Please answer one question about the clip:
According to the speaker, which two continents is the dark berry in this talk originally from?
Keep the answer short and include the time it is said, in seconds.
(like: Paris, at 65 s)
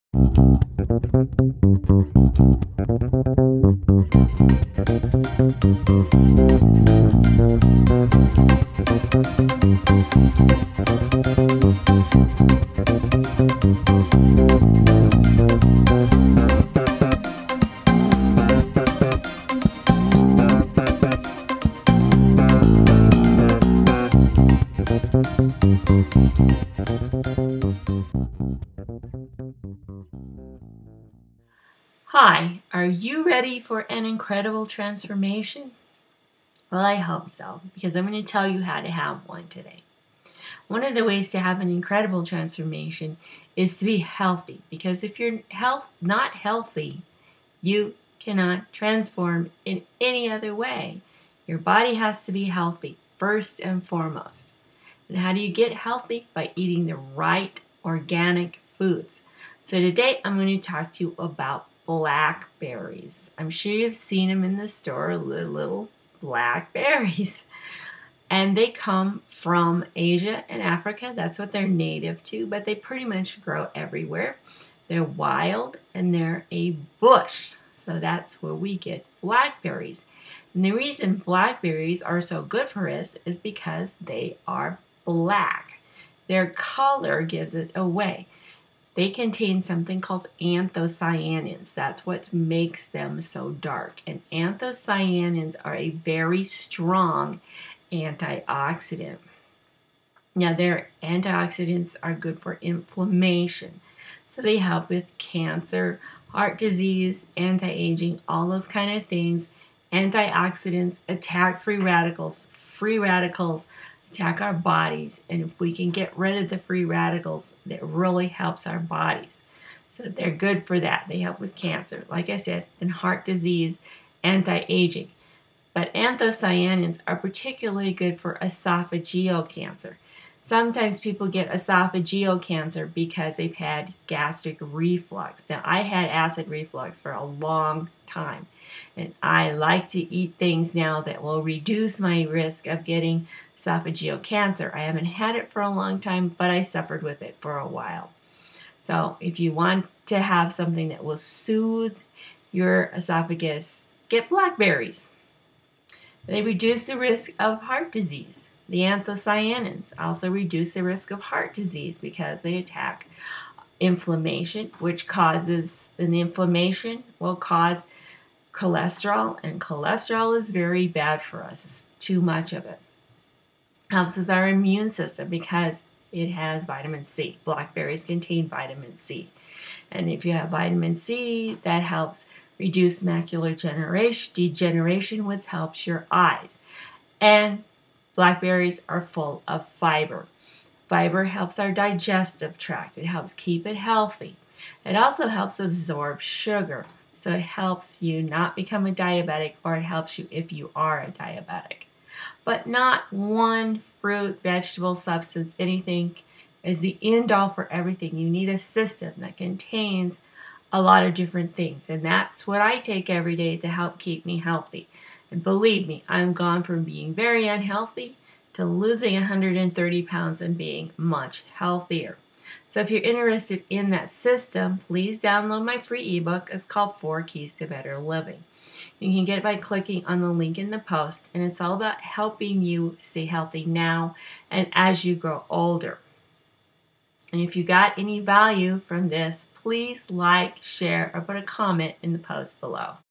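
Asia and Africa, at 69 s.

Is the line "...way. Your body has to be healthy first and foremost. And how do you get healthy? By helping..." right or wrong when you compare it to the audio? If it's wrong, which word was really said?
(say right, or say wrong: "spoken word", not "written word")
wrong: "eating", not "helping".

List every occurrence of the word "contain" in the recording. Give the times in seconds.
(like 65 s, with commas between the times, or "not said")
89 s, 178 s, 209 s.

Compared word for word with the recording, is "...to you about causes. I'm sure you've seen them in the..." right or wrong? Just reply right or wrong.
wrong.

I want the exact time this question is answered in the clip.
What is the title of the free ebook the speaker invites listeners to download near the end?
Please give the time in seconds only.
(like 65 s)
226 s.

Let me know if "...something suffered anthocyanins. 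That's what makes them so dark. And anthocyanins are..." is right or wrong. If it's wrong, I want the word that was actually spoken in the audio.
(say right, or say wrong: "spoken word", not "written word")
wrong: "called", not "suffered".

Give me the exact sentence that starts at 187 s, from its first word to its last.
And Blackberries are full of fiber.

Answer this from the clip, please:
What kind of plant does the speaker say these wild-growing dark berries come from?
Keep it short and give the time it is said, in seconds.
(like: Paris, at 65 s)
A bush, at 76 s.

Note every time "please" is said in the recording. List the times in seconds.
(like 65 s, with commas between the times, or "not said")
224 s, 239 s.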